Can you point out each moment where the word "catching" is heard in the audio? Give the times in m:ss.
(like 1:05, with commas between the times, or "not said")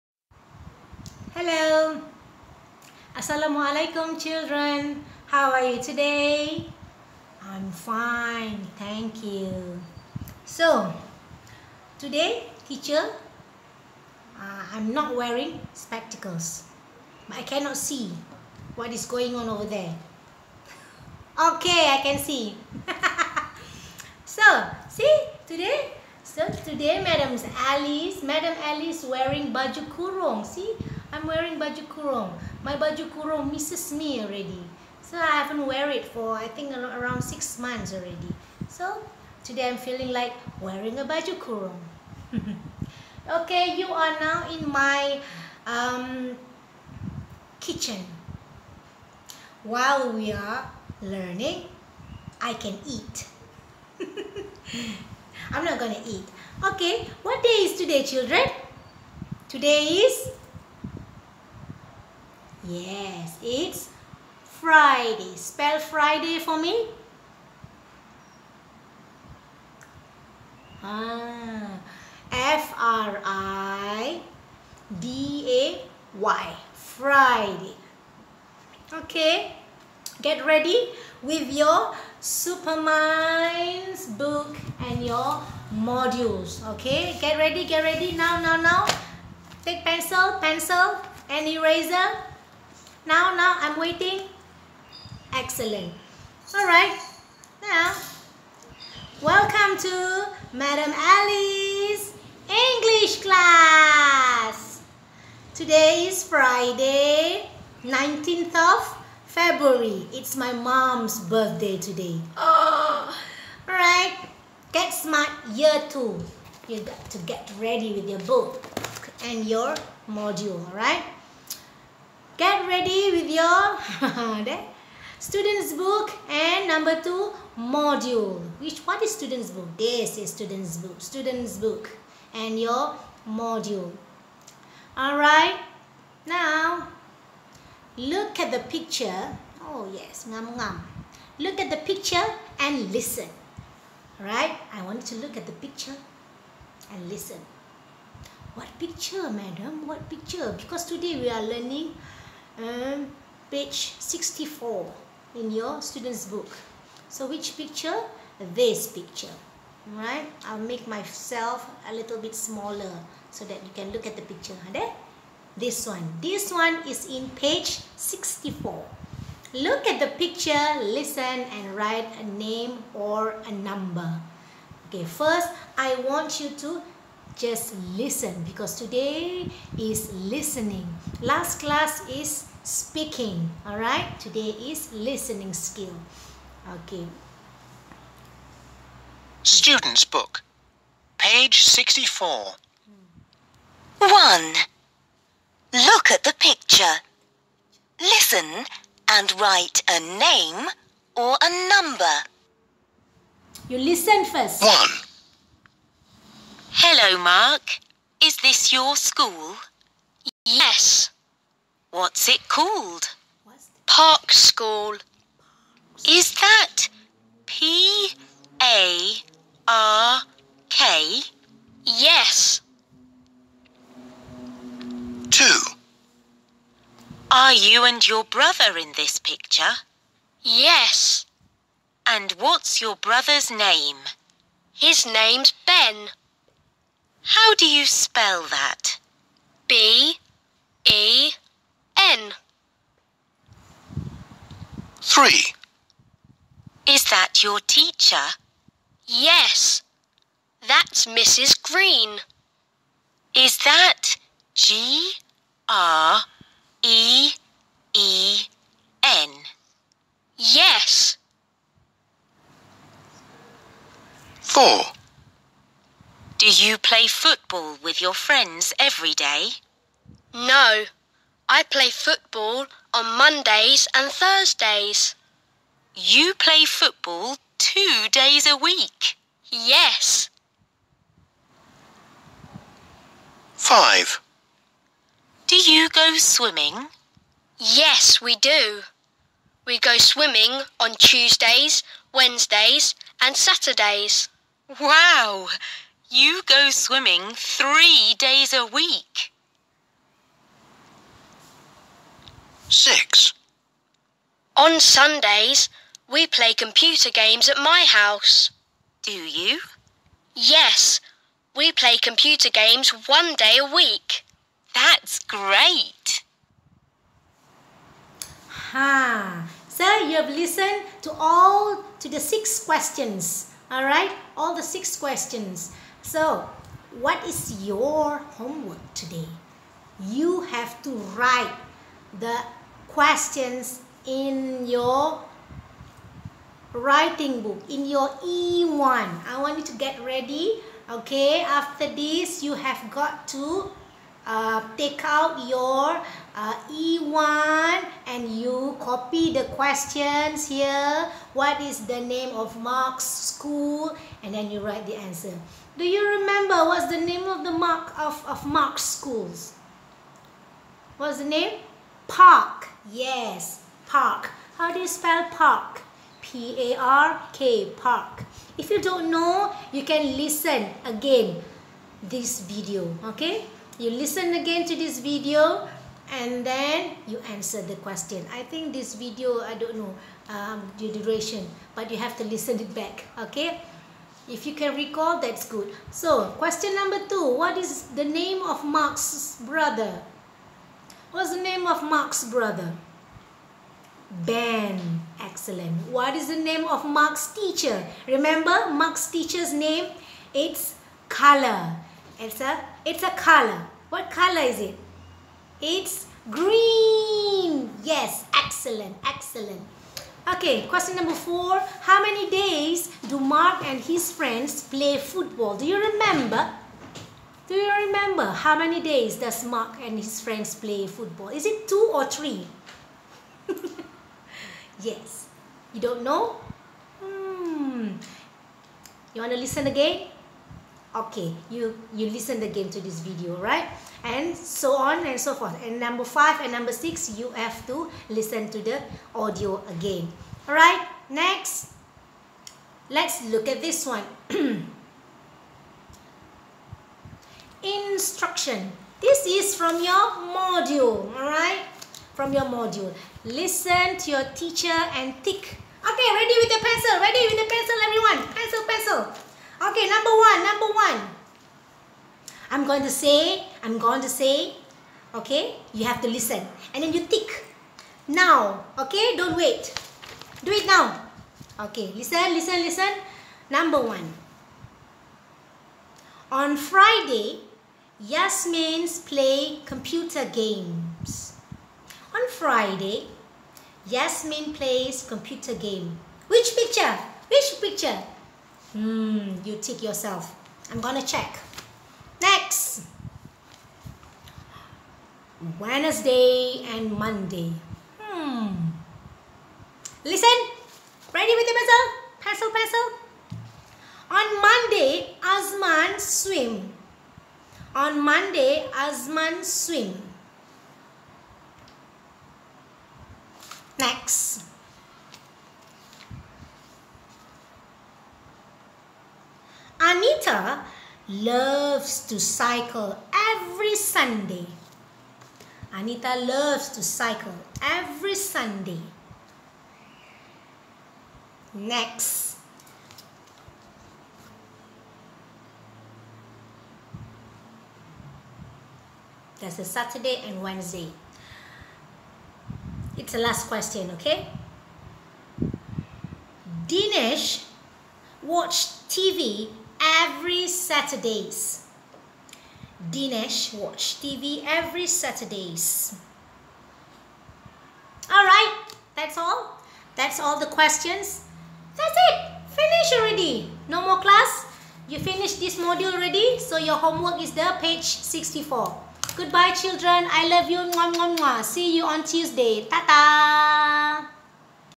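not said.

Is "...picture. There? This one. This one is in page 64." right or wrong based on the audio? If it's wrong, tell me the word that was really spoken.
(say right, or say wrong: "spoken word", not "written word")
right.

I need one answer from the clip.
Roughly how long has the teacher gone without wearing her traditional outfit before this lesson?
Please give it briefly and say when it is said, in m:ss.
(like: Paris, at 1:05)
6 months, at 0:37.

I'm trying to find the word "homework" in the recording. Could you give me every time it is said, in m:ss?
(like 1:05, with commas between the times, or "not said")
5:28, 9:26.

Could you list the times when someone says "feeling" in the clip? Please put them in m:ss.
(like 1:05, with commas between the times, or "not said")
0:39.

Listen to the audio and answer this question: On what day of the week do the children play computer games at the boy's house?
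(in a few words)
Sundays.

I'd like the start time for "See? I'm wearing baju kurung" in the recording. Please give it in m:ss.
0:30.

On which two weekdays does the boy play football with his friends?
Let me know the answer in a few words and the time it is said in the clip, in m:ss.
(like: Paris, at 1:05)
Mondays and Thursdays, at 4:33.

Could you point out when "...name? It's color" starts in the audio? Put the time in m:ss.
6:39.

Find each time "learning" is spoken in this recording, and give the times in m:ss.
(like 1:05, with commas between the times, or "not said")
0:51, 2:31.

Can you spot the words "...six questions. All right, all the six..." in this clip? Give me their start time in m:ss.
5:22.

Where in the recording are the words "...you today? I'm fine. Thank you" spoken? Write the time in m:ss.
0:05.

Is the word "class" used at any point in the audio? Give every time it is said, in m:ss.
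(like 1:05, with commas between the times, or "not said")
1:43, 3:01, 9:23.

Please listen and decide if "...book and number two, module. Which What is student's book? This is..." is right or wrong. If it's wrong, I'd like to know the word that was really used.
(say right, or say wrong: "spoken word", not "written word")
right.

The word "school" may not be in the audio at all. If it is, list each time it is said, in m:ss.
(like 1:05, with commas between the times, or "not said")
3:28, 3:34, 5:53, 5:58.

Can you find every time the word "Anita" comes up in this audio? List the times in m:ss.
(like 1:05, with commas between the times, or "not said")
8:39, 8:45.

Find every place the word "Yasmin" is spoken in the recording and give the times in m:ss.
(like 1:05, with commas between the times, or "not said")
7:57, 8:03.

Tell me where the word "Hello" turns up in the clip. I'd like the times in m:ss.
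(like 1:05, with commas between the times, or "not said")
0:01, 3:26.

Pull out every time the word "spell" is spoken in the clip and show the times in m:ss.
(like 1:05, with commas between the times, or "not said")
1:05, 3:57, 6:04.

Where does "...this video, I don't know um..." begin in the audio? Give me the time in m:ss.
6:18.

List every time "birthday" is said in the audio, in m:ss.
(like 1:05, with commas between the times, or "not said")
1:51.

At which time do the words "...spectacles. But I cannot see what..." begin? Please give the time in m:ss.
0:15.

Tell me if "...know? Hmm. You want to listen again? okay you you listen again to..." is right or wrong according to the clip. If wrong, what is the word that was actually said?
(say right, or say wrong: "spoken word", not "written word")
right.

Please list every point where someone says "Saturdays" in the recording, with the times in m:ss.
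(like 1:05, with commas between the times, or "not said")
4:53, 8:59, 9:10, 9:14.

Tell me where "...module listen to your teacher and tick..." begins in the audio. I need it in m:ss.
7:32.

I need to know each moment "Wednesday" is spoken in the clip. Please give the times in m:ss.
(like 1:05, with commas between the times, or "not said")
4:52, 8:15, 9:00.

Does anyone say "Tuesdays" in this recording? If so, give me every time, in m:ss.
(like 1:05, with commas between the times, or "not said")
4:50, 9:32.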